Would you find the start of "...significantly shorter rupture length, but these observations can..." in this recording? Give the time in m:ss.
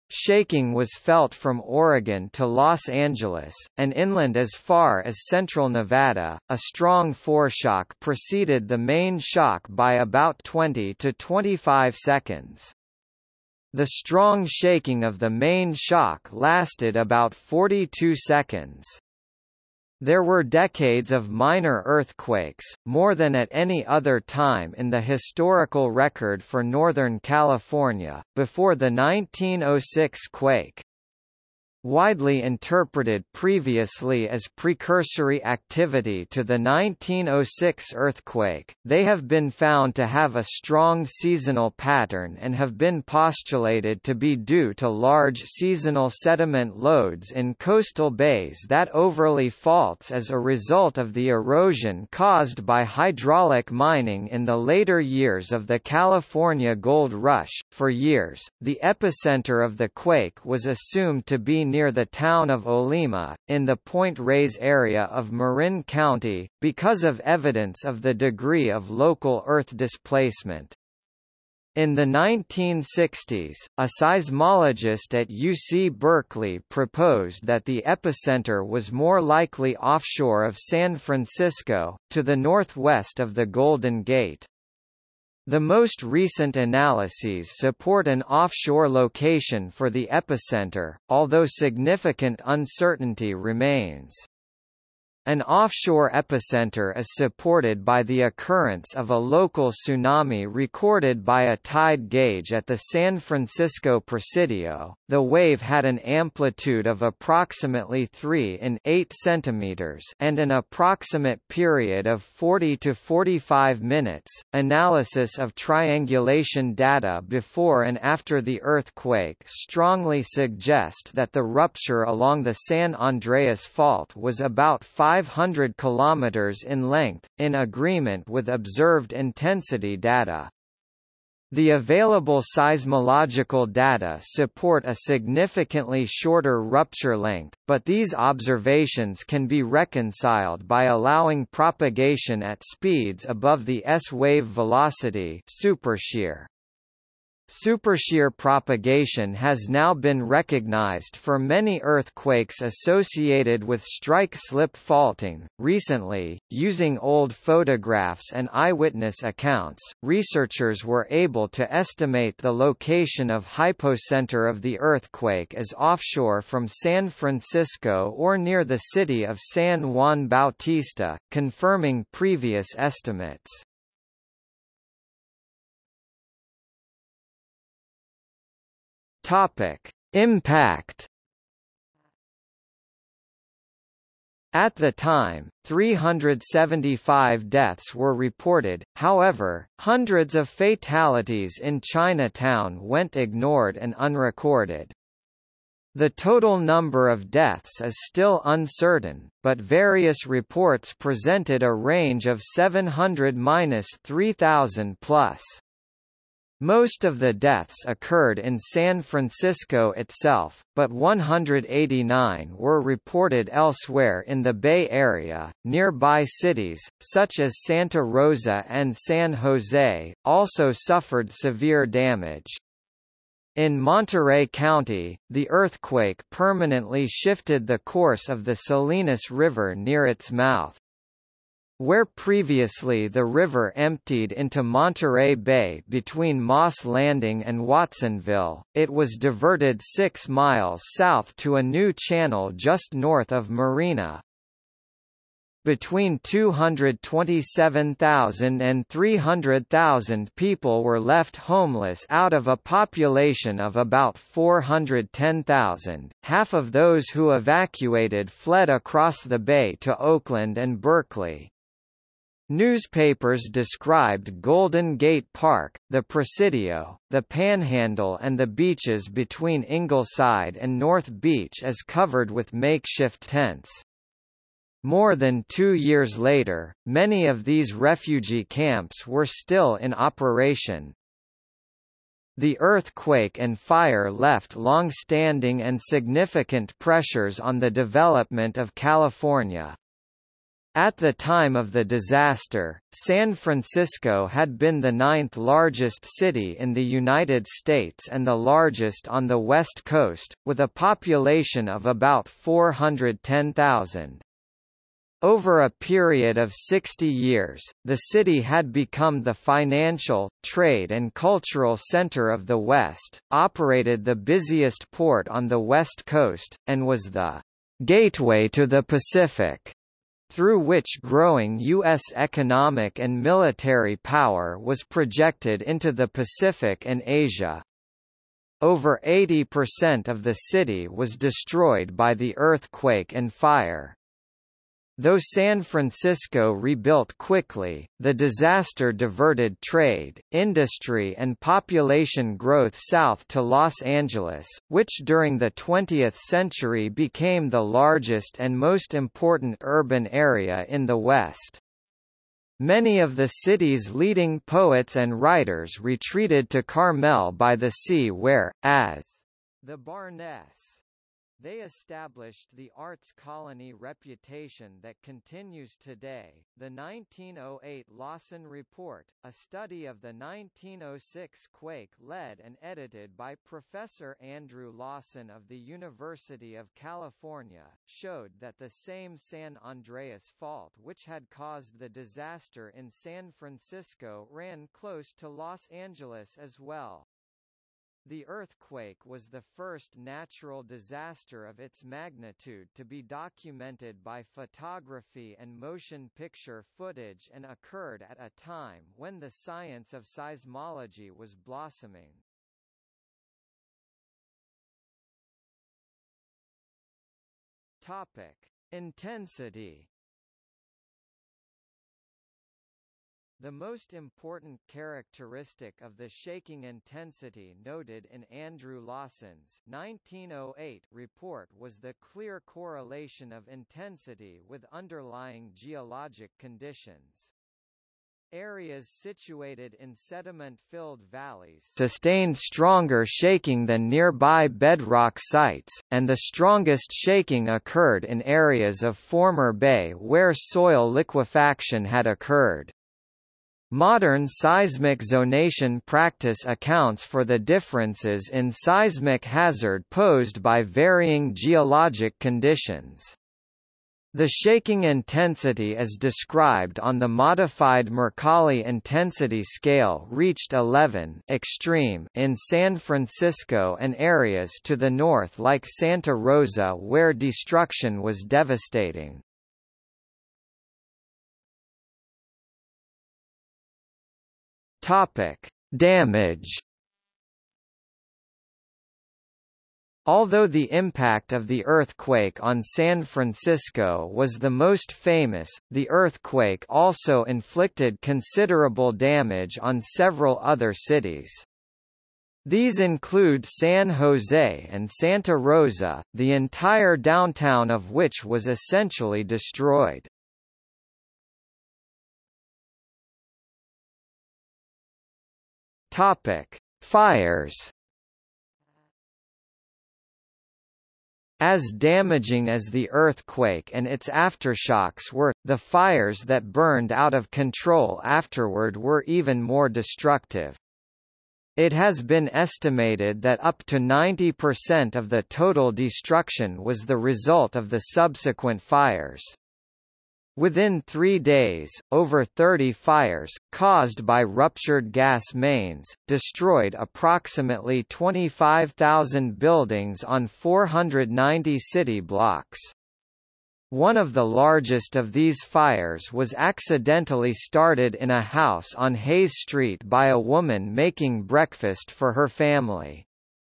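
2:14.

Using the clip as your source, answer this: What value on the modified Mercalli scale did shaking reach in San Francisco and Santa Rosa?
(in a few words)
11.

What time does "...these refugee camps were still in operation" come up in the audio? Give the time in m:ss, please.
4:37.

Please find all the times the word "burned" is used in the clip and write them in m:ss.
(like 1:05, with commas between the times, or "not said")
8:36.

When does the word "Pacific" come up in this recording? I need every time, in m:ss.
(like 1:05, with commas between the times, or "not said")
5:18, 5:26.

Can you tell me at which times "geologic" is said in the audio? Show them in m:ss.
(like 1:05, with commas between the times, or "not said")
7:05, 7:31.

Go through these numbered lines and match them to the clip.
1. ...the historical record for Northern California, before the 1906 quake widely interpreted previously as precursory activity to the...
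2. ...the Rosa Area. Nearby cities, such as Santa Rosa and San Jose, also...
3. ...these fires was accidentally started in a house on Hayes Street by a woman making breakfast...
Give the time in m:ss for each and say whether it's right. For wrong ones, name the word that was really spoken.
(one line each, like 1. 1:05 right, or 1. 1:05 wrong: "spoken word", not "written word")
1. 0:24 right
2. 3:34 wrong: "Bay", not "Rosa"
3. 9:05 right.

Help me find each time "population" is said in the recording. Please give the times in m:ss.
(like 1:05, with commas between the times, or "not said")
4:12, 5:00, 5:41.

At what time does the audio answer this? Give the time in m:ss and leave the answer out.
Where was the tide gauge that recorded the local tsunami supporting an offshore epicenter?
1:42.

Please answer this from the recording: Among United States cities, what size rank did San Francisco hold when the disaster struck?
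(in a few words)
ninth largest.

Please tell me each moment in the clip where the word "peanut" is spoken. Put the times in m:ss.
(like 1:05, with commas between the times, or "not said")
not said.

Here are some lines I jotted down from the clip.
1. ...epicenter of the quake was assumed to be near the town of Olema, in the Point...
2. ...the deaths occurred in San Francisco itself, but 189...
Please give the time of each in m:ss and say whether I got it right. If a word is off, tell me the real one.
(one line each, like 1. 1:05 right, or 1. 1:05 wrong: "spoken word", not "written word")
1. 0:58 right
2. 3:27 right.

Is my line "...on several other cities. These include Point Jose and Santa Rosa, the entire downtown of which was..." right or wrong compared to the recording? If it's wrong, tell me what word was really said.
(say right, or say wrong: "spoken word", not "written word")
wrong: "San", not "Point".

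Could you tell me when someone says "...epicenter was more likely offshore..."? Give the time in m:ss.
1:17.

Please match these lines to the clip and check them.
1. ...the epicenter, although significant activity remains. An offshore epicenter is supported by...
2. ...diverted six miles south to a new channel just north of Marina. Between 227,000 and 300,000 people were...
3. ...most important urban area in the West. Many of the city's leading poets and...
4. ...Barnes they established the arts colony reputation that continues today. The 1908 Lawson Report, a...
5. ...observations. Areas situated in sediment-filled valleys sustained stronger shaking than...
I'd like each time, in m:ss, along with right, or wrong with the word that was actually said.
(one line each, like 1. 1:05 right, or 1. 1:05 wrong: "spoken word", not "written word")
1. 1:29 wrong: "uncertainty", not "activity"
2. 3:59 right
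3. 5:48 right
4. 5:59 right
5. 7:06 wrong: "conditions", not "observations".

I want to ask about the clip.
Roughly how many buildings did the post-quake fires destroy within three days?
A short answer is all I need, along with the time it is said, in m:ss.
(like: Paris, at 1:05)
25,000, at 8:57.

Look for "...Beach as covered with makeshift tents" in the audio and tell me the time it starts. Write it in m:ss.
4:31.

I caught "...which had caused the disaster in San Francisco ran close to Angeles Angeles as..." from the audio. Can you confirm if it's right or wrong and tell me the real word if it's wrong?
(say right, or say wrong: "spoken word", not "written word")
wrong: "Los", not "Angeles".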